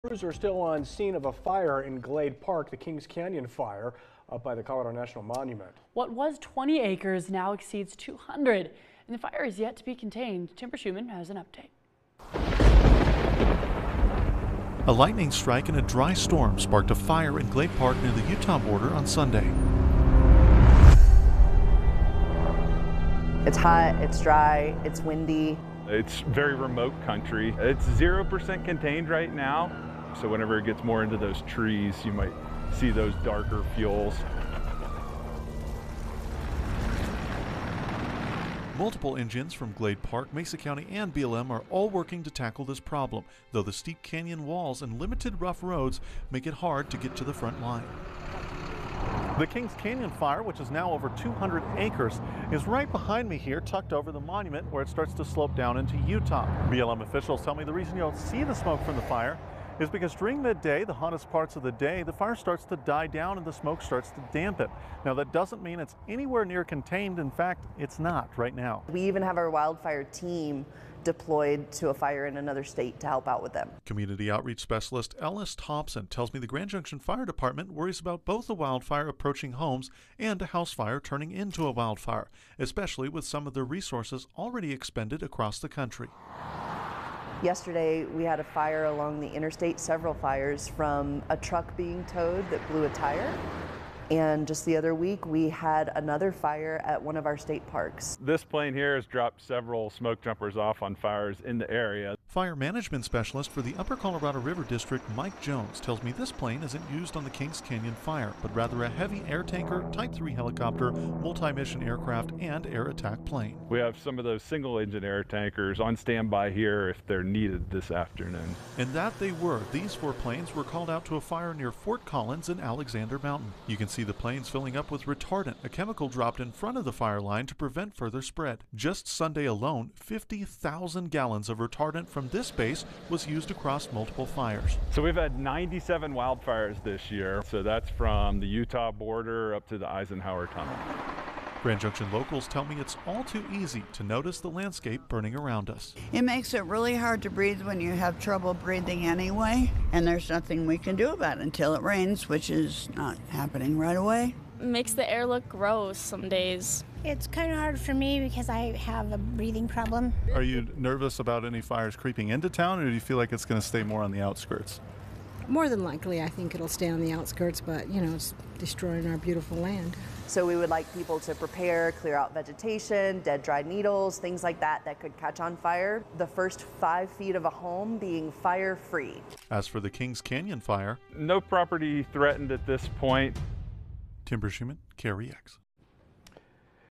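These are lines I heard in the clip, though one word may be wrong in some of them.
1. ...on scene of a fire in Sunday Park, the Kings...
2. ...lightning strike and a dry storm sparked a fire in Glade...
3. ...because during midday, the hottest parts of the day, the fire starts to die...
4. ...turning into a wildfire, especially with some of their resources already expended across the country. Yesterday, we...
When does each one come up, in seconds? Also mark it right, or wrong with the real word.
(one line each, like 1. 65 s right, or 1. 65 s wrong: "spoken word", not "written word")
1. 0 s wrong: "Glade", not "Sunday"
2. 14 s right
3. 59 s right
4. 80 s right.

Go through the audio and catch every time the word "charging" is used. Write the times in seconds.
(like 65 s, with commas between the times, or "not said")
not said.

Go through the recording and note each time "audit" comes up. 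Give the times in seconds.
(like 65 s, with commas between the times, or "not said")
not said.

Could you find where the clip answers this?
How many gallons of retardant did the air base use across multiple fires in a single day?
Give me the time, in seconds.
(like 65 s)
129 s.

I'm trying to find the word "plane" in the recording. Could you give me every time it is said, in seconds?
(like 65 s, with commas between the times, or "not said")
98 s, 106 s, 113 s, 120 s, 124 s.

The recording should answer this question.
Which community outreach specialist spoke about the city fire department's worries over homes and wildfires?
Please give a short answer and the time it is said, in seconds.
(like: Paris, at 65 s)
Ellis Thompson, at 75 s.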